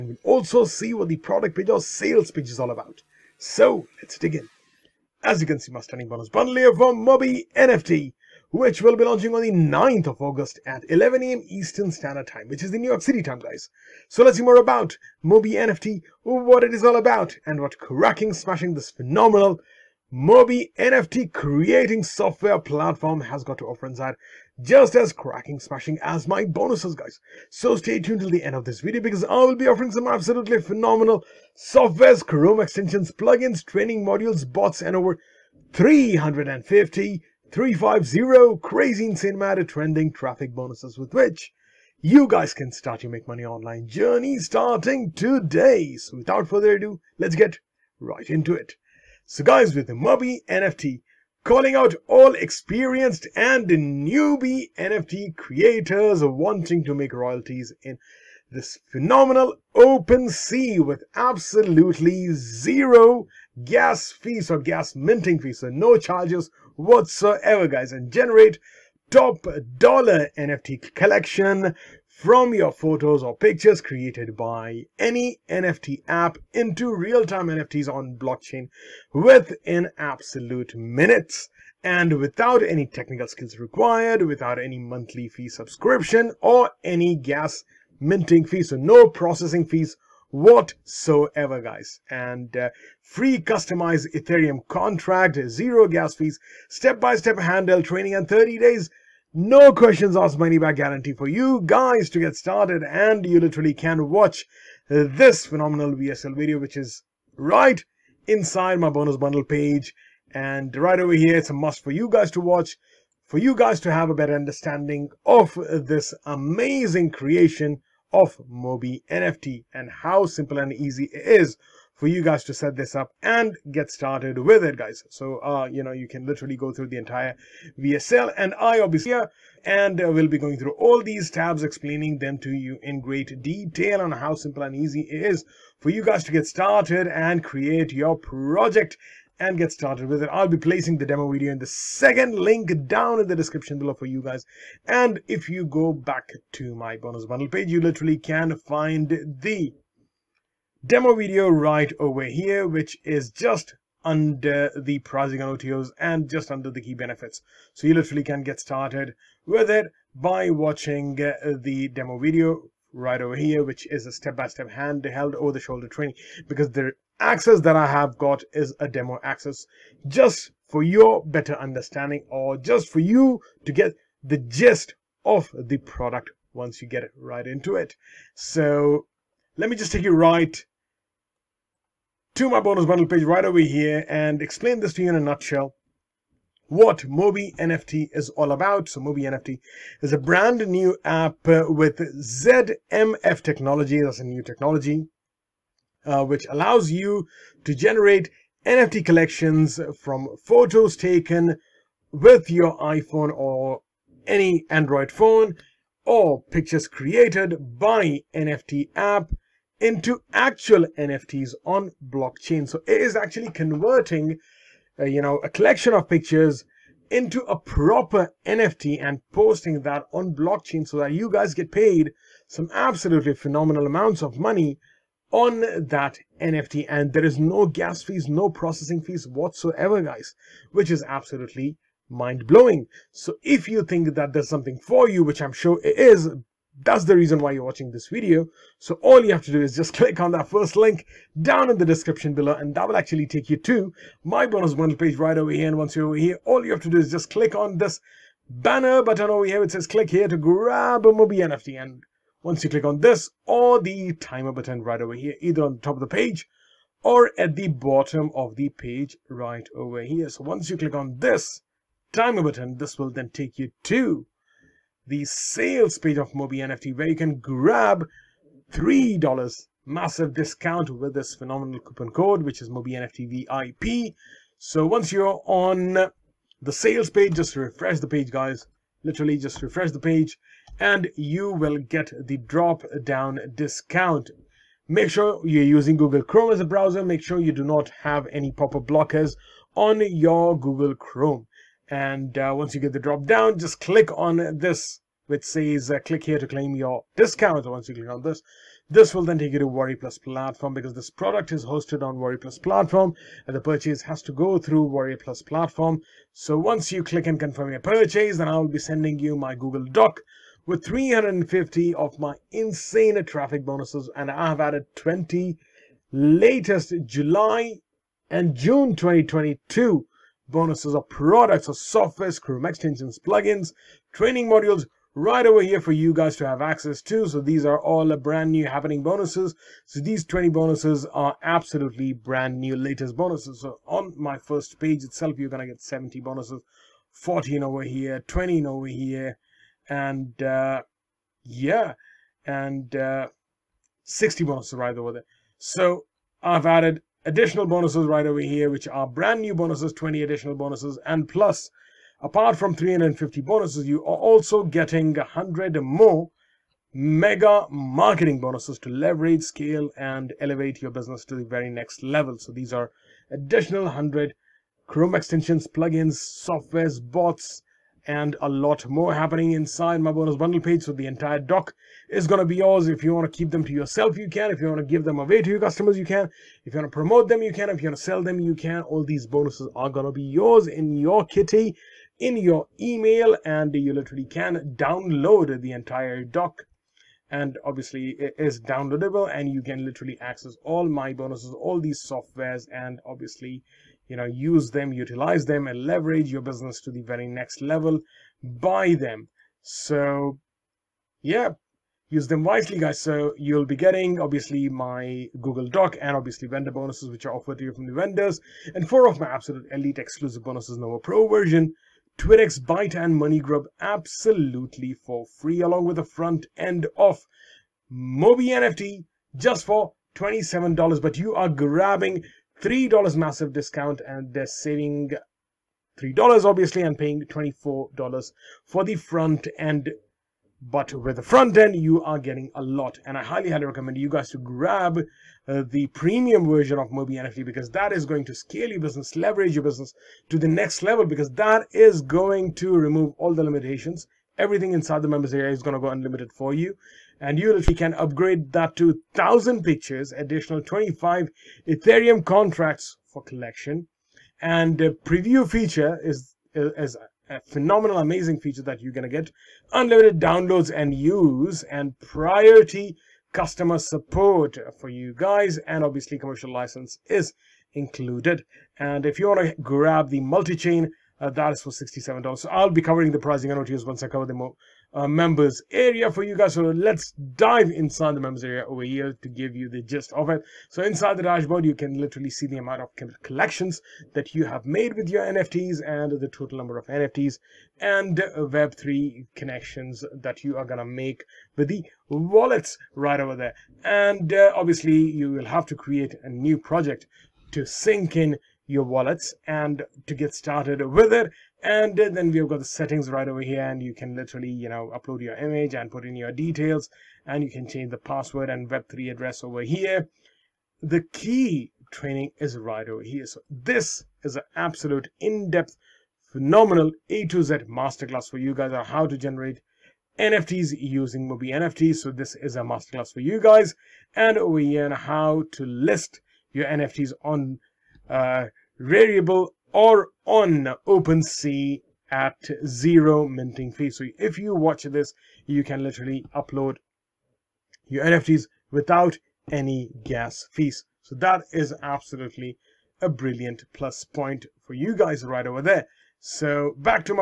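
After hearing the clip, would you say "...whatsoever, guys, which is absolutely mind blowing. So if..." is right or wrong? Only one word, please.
right.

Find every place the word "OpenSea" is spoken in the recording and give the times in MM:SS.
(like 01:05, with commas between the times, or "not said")
00:59, 08:50.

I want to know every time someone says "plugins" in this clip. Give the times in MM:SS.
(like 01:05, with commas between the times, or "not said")
00:33, 05:23, 06:05.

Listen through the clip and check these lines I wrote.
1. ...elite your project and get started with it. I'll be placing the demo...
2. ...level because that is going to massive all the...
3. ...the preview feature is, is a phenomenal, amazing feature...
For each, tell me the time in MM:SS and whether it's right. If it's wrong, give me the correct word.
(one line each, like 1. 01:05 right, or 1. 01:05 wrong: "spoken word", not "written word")
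1. 02:17 wrong: "create", not "elite"
2. 07:20 wrong: "remove", not "massive"
3. 07:34 right.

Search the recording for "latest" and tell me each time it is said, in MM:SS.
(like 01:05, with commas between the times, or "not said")
05:16, 05:32.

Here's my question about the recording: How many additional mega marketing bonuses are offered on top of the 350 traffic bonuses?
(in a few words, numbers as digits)
100.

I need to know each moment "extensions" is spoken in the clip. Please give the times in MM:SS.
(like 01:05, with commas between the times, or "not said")
00:32, 05:22, 06:05.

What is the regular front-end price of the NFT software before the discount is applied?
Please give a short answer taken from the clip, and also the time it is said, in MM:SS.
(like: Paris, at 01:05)
$27, at 07:00.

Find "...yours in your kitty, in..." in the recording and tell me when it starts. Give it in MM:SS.
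06:20.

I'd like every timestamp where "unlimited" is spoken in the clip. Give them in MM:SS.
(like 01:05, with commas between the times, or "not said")
07:25, 07:39.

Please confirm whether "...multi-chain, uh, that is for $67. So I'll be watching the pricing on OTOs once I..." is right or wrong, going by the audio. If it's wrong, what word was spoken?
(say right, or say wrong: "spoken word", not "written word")
wrong: "covering", not "watching".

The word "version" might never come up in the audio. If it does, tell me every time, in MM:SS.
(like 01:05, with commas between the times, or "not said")
06:51, 07:16.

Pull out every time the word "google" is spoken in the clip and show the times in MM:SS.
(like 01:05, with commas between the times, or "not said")
04:45, 04:50, 05:09, 06:45.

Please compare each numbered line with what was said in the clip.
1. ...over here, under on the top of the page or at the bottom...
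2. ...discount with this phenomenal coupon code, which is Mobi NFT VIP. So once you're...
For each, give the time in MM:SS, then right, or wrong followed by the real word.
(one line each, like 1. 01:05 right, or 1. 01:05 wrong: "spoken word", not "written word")
1. 04:15 wrong: "either", not "under"
2. 04:30 right.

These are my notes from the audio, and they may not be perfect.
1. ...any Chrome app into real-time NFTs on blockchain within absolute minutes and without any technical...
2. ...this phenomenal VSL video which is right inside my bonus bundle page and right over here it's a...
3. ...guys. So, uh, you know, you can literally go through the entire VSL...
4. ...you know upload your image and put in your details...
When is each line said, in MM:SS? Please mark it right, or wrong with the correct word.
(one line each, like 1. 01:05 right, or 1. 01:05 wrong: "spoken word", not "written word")
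1. 01:14 wrong: "NFT", not "Chrome"
2. 01:44 right
3. 02:04 right
4. 08:24 right.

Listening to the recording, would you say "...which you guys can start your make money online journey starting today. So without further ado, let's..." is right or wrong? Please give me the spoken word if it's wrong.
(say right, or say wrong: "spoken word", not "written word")
right.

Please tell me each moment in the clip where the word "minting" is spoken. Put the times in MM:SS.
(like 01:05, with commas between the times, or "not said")
01:04, 01:28, 08:53.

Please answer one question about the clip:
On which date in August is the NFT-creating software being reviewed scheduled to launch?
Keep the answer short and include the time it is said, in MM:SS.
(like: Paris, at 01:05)
9th of August, at 00:09.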